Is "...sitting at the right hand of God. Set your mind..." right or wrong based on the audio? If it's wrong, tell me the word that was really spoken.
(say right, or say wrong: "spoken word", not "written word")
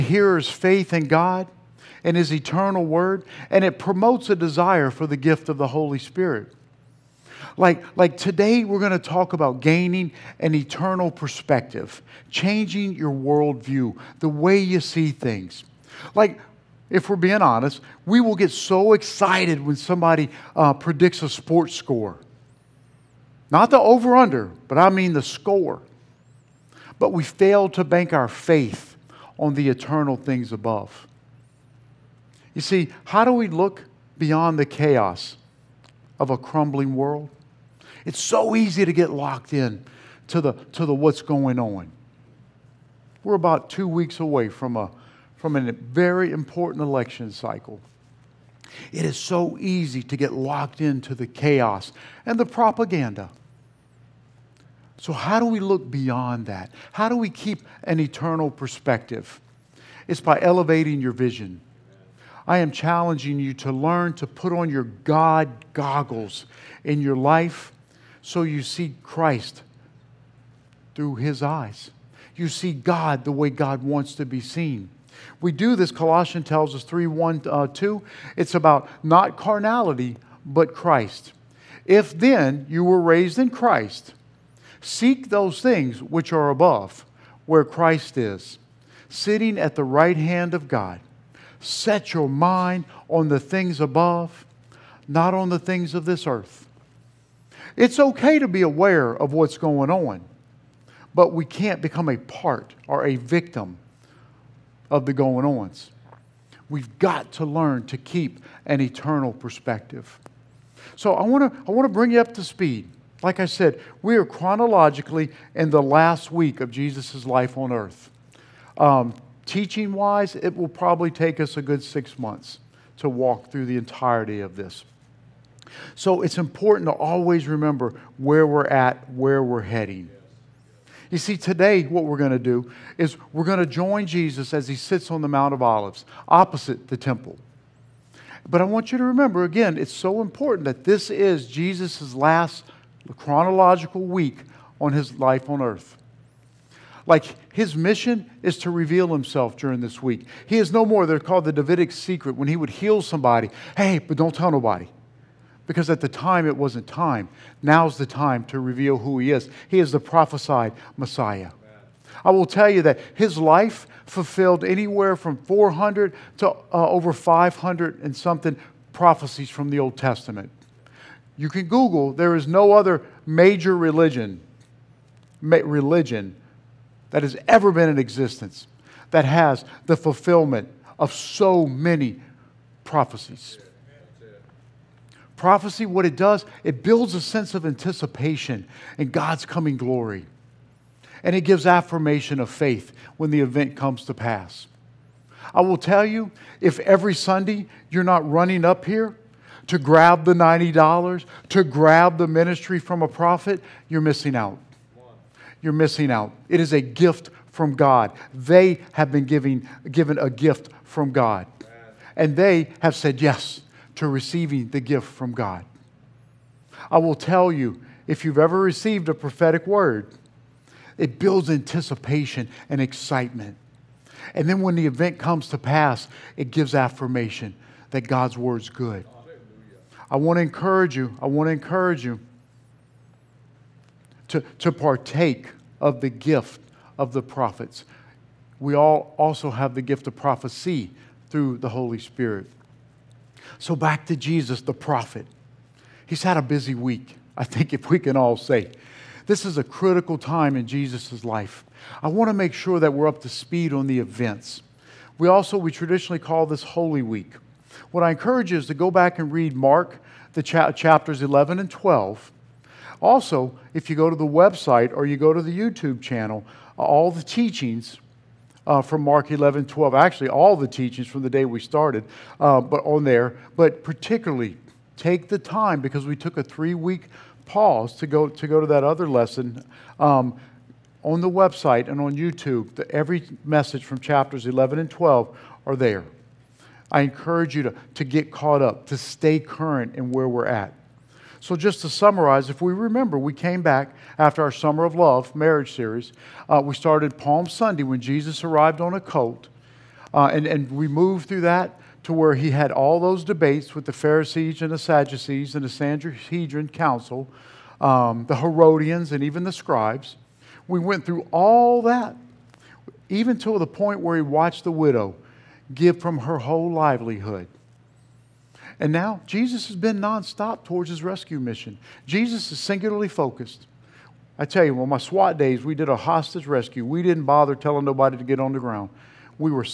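right.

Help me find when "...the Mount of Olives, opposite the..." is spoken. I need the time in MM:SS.
02:15.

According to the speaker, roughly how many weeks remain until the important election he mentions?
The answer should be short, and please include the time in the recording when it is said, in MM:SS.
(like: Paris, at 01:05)
2, at 00:43.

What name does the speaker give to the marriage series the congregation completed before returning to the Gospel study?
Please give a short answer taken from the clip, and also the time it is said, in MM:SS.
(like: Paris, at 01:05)
Summer of Love, at 04:54.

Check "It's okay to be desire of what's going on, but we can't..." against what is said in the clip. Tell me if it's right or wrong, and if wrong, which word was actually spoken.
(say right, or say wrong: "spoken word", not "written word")
wrong: "aware", not "desire".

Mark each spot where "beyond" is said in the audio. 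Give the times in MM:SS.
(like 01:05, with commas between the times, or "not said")
00:34, 00:55.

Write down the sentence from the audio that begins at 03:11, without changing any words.
And it gives affirmation of faith when the event comes to pass.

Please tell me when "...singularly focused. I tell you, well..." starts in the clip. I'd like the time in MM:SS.
05:22.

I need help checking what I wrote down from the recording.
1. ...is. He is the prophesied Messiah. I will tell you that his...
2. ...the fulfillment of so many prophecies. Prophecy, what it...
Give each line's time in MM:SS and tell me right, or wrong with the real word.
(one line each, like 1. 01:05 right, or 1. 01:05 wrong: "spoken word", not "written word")
1. 02:39 right
2. 02:59 right.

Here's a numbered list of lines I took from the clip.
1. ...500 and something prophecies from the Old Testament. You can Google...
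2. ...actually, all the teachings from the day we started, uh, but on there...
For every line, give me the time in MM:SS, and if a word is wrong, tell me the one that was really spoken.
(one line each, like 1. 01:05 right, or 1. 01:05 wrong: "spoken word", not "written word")
1. 02:47 right
2. 04:29 right.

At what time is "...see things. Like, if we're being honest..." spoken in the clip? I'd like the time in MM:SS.
00:14.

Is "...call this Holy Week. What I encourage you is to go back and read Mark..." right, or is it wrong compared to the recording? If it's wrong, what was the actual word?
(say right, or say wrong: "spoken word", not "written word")
right.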